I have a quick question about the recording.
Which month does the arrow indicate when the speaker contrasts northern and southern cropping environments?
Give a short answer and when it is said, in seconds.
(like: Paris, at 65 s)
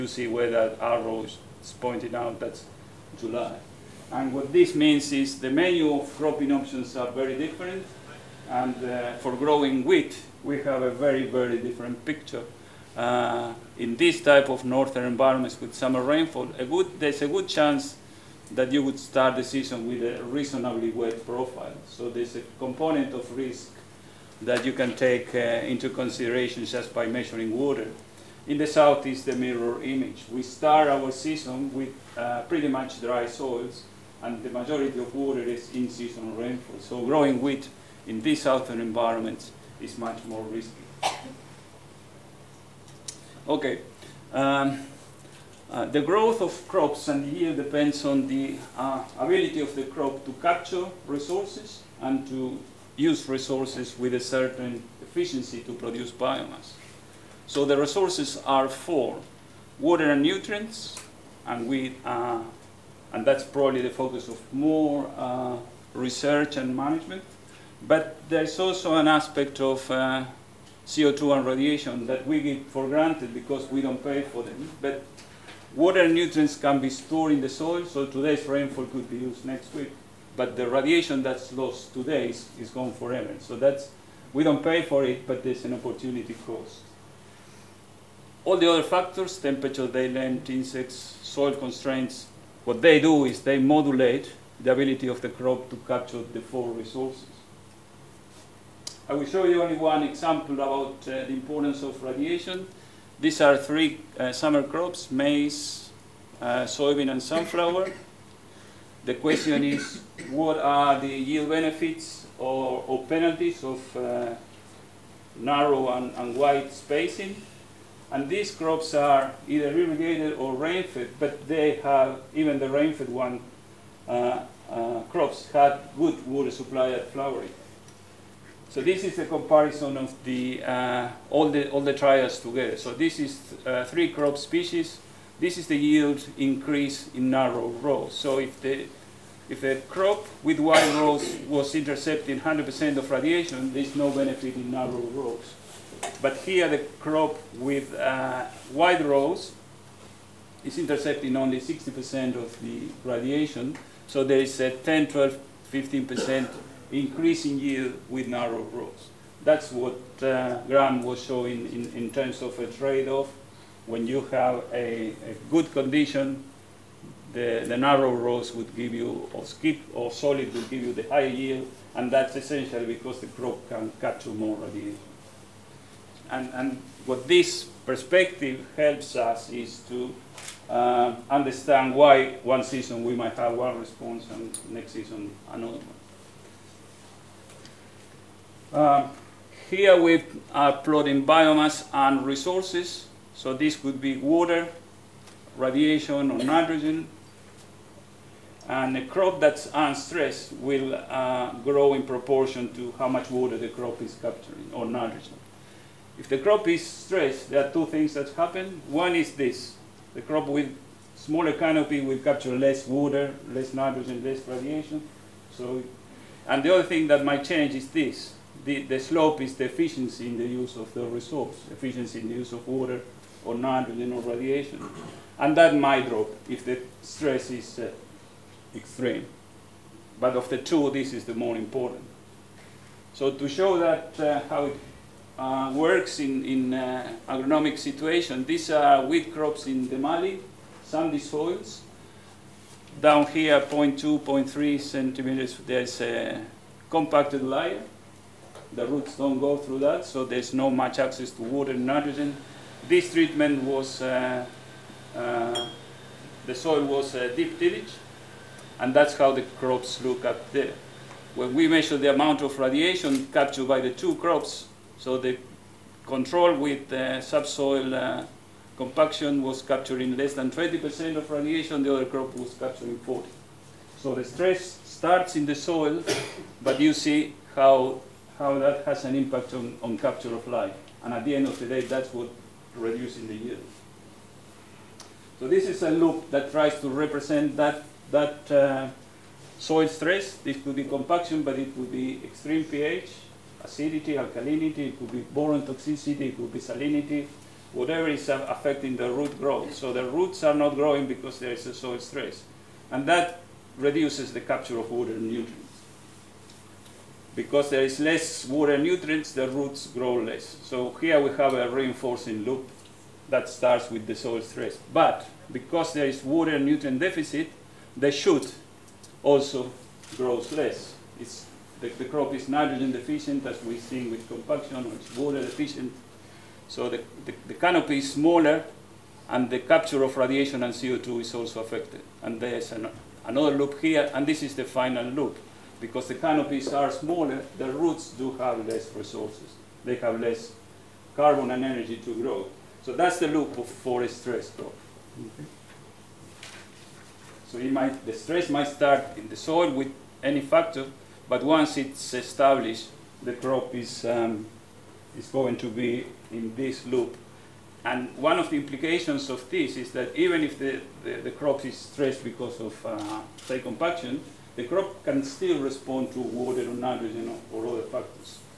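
July, at 3 s.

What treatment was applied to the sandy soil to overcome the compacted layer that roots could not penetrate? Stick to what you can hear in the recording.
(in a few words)
deep tillage.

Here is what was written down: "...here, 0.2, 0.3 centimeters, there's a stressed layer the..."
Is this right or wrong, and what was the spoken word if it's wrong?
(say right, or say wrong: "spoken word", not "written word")
wrong: "compacted", not "stressed".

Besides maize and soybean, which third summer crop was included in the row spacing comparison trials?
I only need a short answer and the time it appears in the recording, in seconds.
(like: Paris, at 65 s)
sunflower, at 107 s.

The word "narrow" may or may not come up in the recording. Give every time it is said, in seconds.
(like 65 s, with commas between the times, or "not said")
115 s, 137 s, 144 s, 158 s, 167 s.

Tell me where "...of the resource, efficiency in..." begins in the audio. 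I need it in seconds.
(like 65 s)
220 s.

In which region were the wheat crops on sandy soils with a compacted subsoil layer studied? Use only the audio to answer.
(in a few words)
the Mallee.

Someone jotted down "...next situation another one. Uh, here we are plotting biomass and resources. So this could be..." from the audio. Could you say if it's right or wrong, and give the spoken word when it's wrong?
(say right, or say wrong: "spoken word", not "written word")
wrong: "season", not "situation".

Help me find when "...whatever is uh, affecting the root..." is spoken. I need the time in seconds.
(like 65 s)
297 s.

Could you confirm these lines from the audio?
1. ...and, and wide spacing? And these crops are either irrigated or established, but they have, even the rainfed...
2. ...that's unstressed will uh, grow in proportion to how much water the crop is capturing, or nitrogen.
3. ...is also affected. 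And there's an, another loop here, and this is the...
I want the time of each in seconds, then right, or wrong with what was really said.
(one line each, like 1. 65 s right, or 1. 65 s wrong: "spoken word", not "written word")
1. 115 s wrong: "rainfed", not "established"
2. 199 s right
3. 331 s right.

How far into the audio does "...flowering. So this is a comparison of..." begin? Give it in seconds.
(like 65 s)
127 s.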